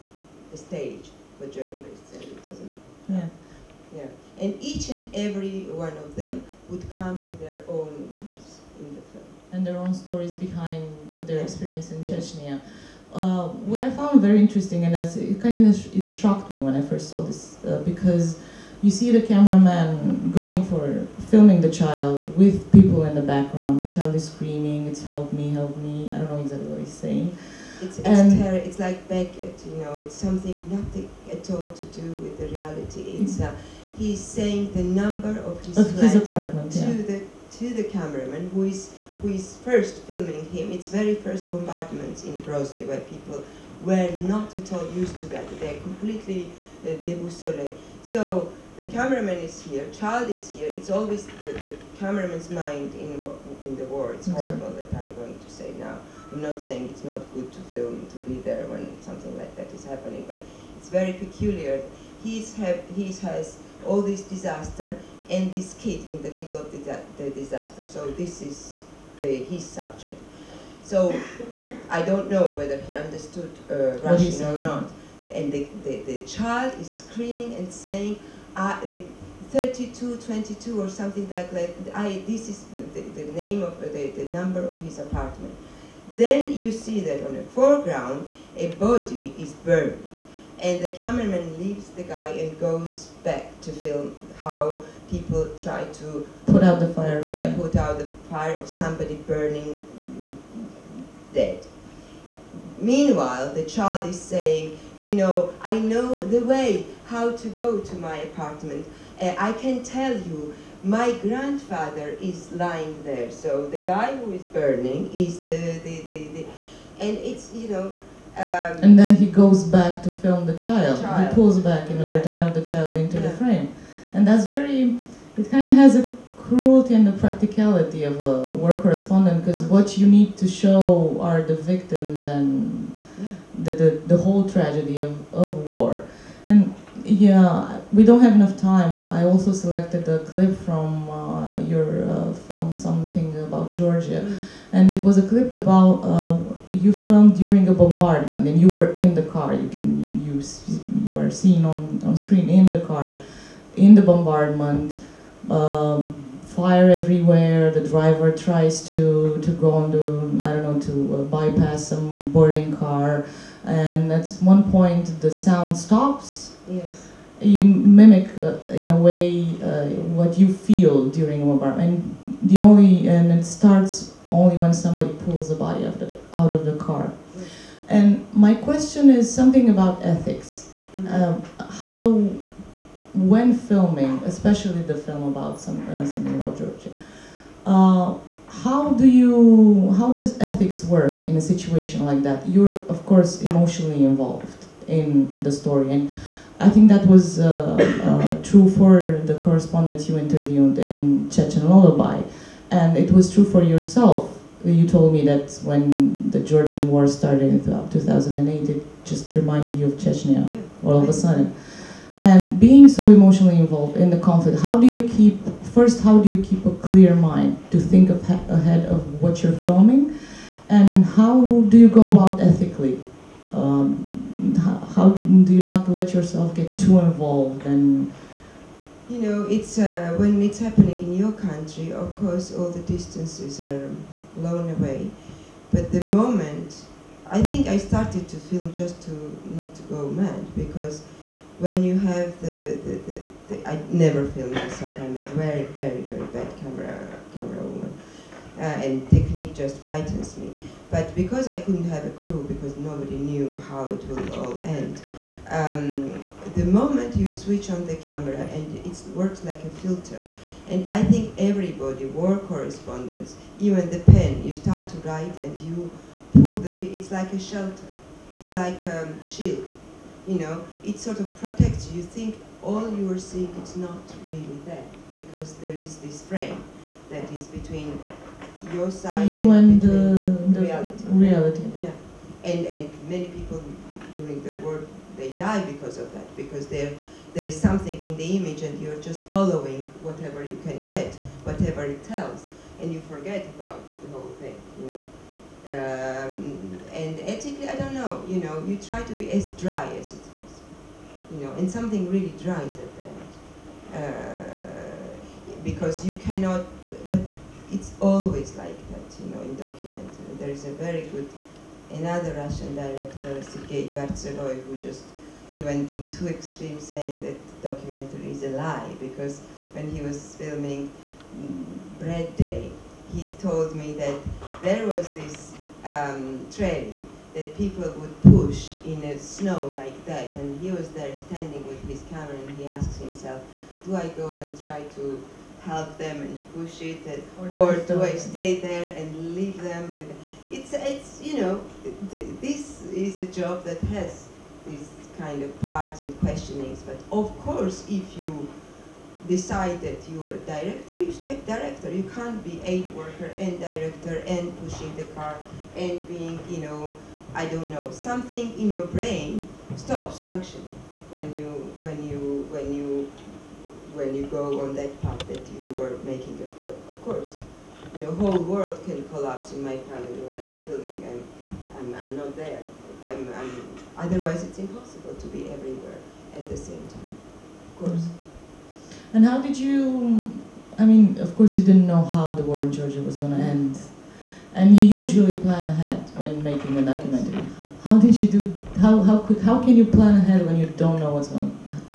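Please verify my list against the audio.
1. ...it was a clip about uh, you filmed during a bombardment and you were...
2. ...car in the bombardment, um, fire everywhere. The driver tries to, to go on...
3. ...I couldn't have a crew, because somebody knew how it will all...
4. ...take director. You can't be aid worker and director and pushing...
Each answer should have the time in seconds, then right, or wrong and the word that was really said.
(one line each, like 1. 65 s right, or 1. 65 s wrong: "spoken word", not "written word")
1. 144 s right
2. 152 s right
3. 251 s wrong: "nobody", not "somebody"
4. 351 s right.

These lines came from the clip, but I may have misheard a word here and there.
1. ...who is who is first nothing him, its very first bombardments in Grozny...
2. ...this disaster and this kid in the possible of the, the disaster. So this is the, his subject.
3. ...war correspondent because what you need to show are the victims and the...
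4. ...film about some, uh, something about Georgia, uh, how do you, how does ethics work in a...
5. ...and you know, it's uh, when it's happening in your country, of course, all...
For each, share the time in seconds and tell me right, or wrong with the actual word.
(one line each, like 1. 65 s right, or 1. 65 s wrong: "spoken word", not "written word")
1. 38 s wrong: "filming", not "nothing"
2. 64 s wrong: "middle", not "possible"
3. 128 s right
4. 184 s right
5. 227 s right.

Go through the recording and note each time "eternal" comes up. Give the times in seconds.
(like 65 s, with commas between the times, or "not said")
not said.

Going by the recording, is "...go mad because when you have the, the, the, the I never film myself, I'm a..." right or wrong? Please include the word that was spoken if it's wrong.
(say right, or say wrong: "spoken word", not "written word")
right.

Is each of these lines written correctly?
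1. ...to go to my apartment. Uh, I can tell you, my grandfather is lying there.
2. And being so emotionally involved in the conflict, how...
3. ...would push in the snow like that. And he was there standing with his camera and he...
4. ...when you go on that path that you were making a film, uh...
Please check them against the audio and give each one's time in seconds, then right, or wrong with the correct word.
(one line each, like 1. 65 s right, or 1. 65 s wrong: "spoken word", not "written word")
1. 107 s right
2. 212 s right
3. 327 s right
4. 363 s right.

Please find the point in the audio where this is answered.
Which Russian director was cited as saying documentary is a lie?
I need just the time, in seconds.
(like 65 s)
313 s.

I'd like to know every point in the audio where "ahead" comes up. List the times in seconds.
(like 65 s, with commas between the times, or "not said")
218 s, 385 s, 390 s.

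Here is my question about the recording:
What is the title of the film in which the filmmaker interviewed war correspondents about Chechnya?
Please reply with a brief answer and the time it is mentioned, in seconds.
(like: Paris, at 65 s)
Chechen Lullaby, at 201 s.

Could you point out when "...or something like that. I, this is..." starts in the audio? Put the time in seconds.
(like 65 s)
80 s.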